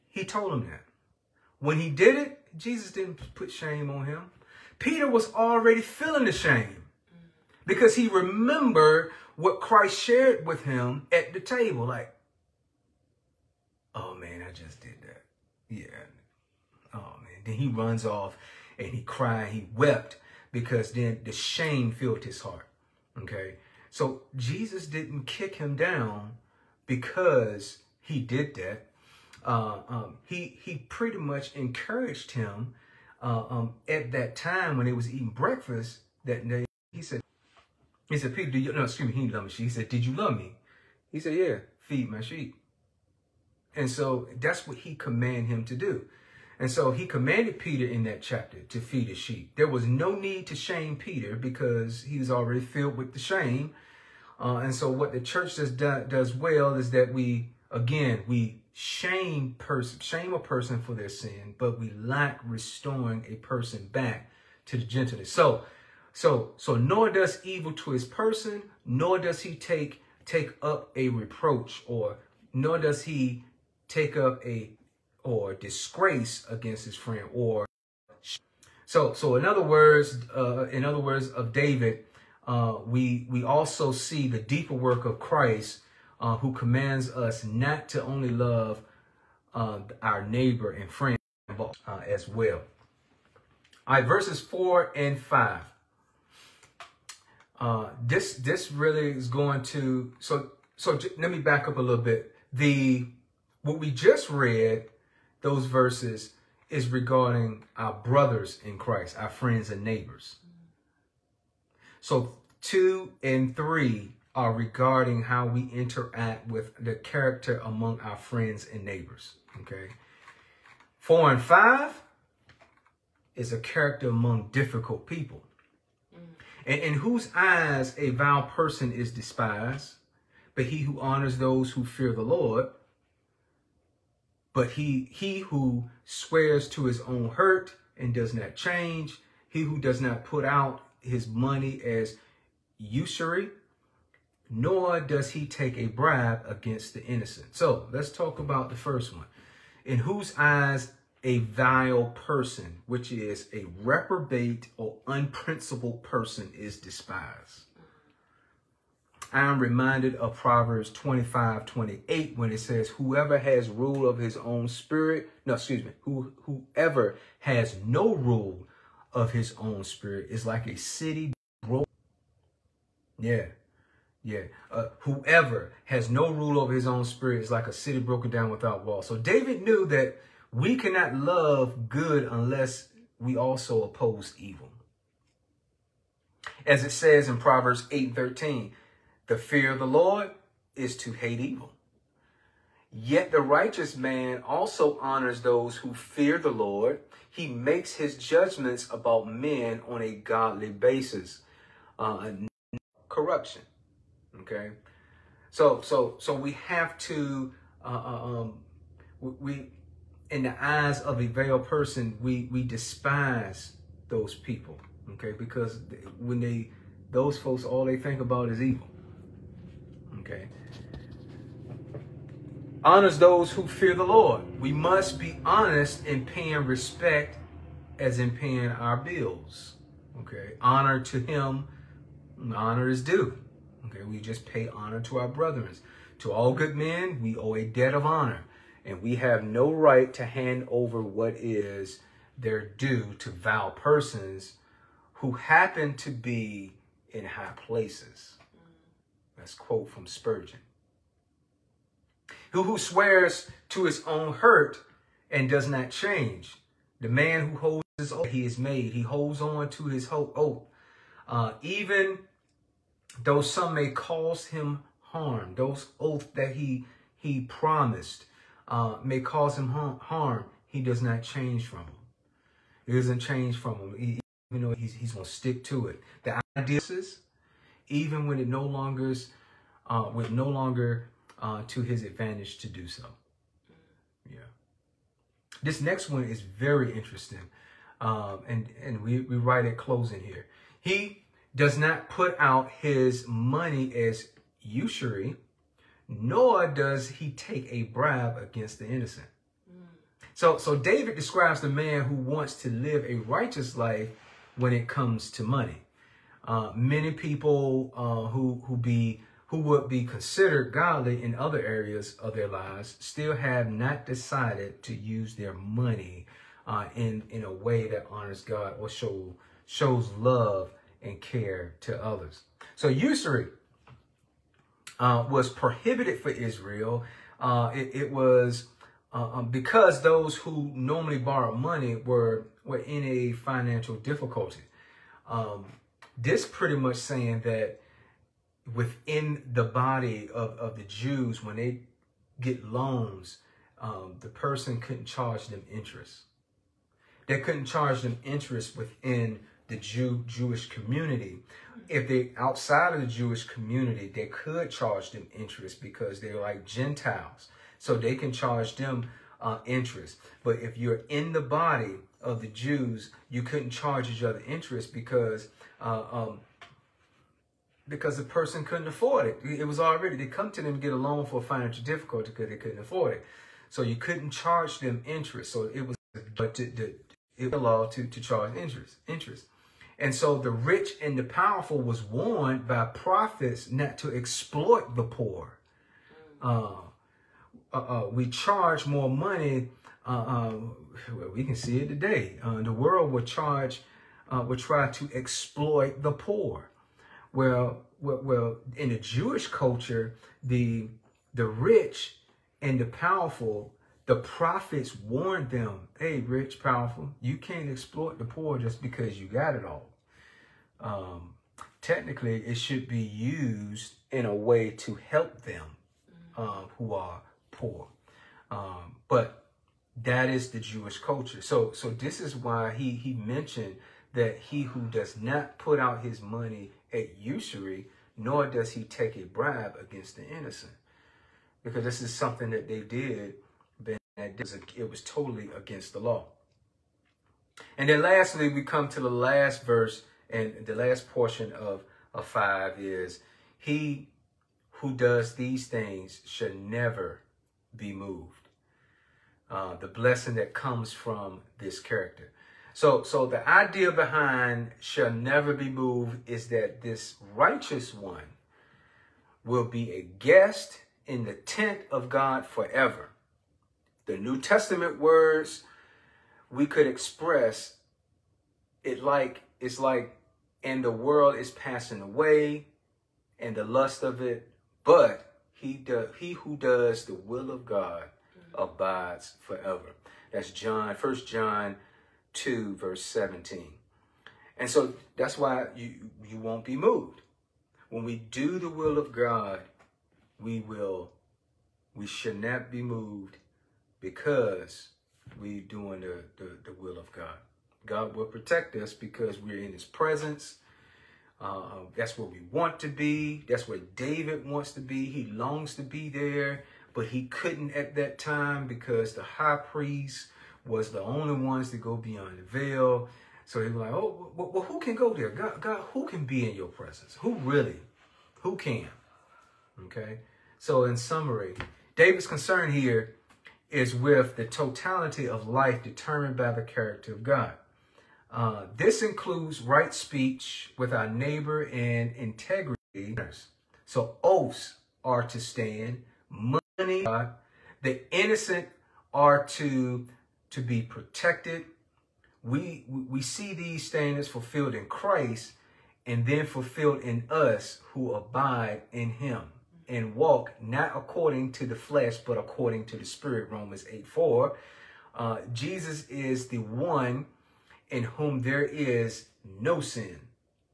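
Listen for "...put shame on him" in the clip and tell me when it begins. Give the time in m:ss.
0:03.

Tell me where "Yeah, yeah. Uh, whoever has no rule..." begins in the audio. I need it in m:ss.
2:53.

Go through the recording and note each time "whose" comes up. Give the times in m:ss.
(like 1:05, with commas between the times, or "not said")
2:06, 2:29.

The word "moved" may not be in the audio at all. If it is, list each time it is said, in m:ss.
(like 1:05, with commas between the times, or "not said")
7:27, 7:35, 8:06, 8:12.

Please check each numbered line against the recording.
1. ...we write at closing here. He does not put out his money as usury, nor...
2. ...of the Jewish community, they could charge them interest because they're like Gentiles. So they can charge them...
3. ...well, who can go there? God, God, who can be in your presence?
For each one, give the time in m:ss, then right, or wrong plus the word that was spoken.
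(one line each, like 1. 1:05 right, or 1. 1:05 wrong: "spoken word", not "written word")
1. 4:49 right
2. 5:52 right
3. 8:34 right.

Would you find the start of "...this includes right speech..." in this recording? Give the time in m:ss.
8:48.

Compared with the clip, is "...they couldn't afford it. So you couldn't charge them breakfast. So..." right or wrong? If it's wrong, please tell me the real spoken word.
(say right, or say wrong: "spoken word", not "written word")
wrong: "interest", not "breakfast".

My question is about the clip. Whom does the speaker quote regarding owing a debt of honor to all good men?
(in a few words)
Spurgeon.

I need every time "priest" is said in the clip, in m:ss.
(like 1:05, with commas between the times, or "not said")
8:29.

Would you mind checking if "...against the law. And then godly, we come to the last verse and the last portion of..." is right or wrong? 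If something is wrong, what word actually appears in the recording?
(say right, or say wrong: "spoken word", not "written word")
wrong: "lastly", not "godly".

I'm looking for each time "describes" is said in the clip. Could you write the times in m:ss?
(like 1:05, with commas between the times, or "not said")
5:01.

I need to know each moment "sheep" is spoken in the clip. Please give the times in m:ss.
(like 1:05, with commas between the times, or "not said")
0:42, 0:49.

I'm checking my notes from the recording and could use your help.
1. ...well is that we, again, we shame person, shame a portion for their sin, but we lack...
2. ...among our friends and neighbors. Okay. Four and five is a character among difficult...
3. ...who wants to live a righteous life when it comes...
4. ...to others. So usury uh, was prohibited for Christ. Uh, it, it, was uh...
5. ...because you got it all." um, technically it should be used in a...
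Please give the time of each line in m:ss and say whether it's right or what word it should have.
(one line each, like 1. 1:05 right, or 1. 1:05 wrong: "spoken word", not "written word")
1. 0:56 wrong: "person", not "portion"
2. 1:57 right
3. 5:02 right
4. 5:21 wrong: "Israel", not "Christ"
5. 6:48 right.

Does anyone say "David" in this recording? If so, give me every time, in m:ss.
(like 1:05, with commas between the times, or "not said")
1:21, 2:59, 5:00, 8:23, 8:41.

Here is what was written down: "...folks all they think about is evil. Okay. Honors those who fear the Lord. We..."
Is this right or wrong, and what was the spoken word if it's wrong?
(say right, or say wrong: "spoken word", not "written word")
right.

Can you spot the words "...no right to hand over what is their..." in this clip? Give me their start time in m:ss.
3:59.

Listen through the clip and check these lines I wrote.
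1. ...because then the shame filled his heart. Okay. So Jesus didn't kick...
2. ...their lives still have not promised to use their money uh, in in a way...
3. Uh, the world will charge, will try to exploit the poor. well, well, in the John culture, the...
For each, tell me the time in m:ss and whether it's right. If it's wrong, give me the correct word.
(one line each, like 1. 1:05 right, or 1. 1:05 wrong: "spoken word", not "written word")
1. 0:20 right
2. 5:12 wrong: "decided", not "promised"
3. 6:32 wrong: "Jewish", not "John".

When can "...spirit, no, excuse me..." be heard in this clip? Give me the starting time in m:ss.
2:44.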